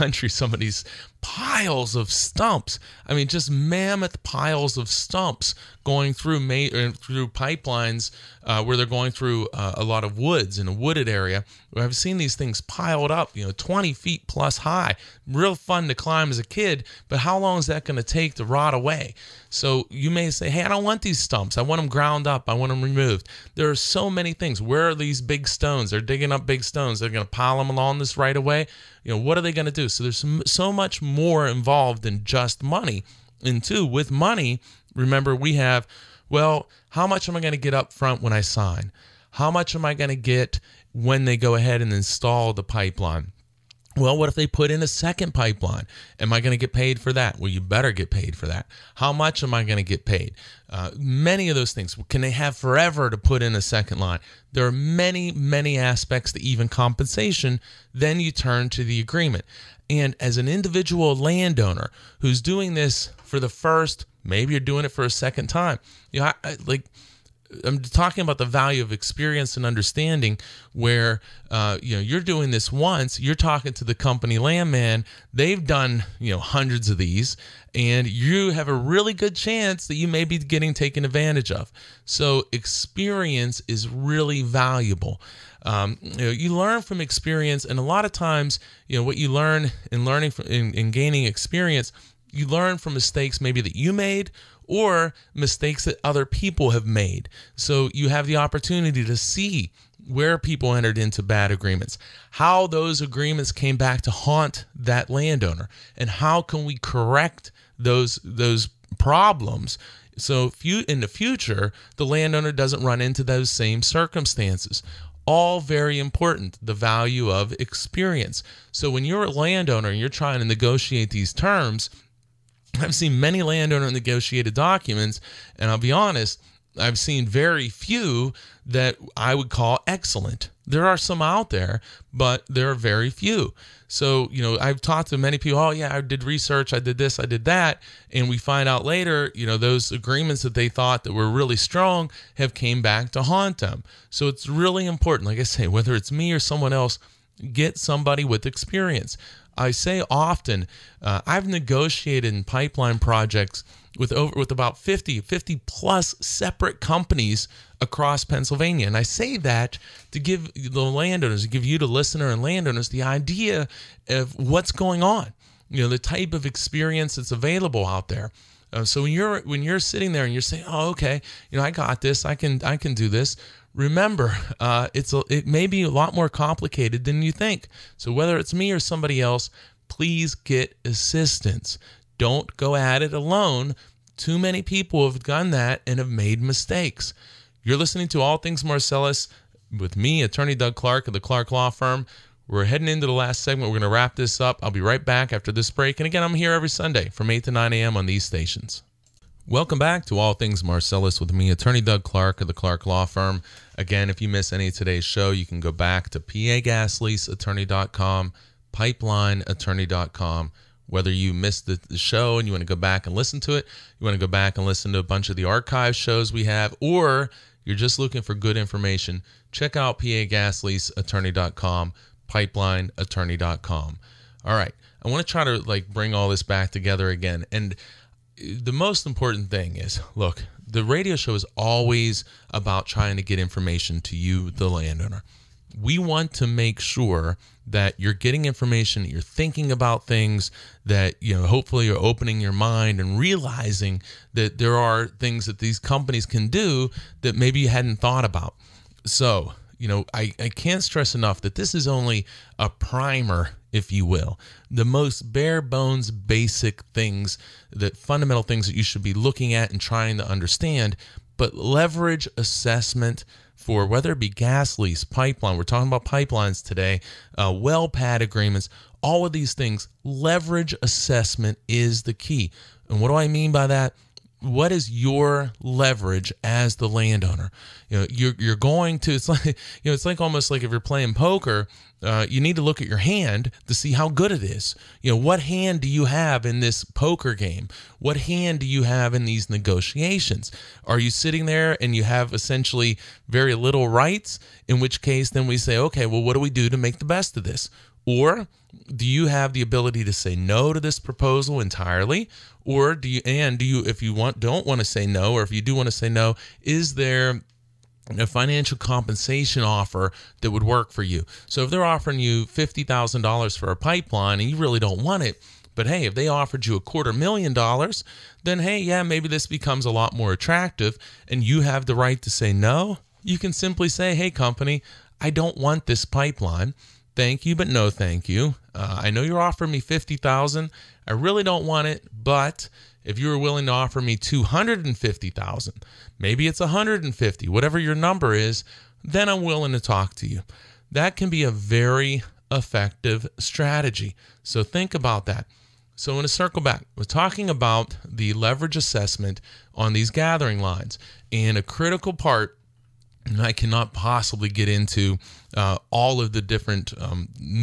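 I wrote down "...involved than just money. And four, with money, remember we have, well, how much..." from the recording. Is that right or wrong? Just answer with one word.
wrong.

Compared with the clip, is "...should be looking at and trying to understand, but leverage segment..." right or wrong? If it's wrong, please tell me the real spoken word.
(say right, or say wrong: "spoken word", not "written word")
wrong: "assessment", not "segment".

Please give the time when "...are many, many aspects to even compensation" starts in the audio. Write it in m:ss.
0:54.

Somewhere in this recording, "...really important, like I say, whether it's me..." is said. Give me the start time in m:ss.
2:24.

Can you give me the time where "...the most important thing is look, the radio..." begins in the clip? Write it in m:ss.
3:48.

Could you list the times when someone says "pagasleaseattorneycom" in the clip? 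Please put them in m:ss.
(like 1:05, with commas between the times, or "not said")
3:26, 3:39.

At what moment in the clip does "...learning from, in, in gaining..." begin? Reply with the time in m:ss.
1:30.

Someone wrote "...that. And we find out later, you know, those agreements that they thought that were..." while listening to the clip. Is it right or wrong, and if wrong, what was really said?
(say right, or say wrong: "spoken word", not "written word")
right.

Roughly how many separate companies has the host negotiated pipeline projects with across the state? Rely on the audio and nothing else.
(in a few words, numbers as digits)
50.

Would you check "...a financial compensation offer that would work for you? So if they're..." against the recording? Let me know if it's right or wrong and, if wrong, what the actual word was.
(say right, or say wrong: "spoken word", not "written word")
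right.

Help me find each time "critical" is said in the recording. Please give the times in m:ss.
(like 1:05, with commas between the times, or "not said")
5:51.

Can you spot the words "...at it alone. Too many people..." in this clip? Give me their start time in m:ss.
3:02.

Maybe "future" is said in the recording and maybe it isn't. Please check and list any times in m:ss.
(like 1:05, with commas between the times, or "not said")
1:51.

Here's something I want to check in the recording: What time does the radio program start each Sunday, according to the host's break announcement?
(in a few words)
8 a.m.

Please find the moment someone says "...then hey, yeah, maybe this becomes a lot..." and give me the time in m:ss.
5:18.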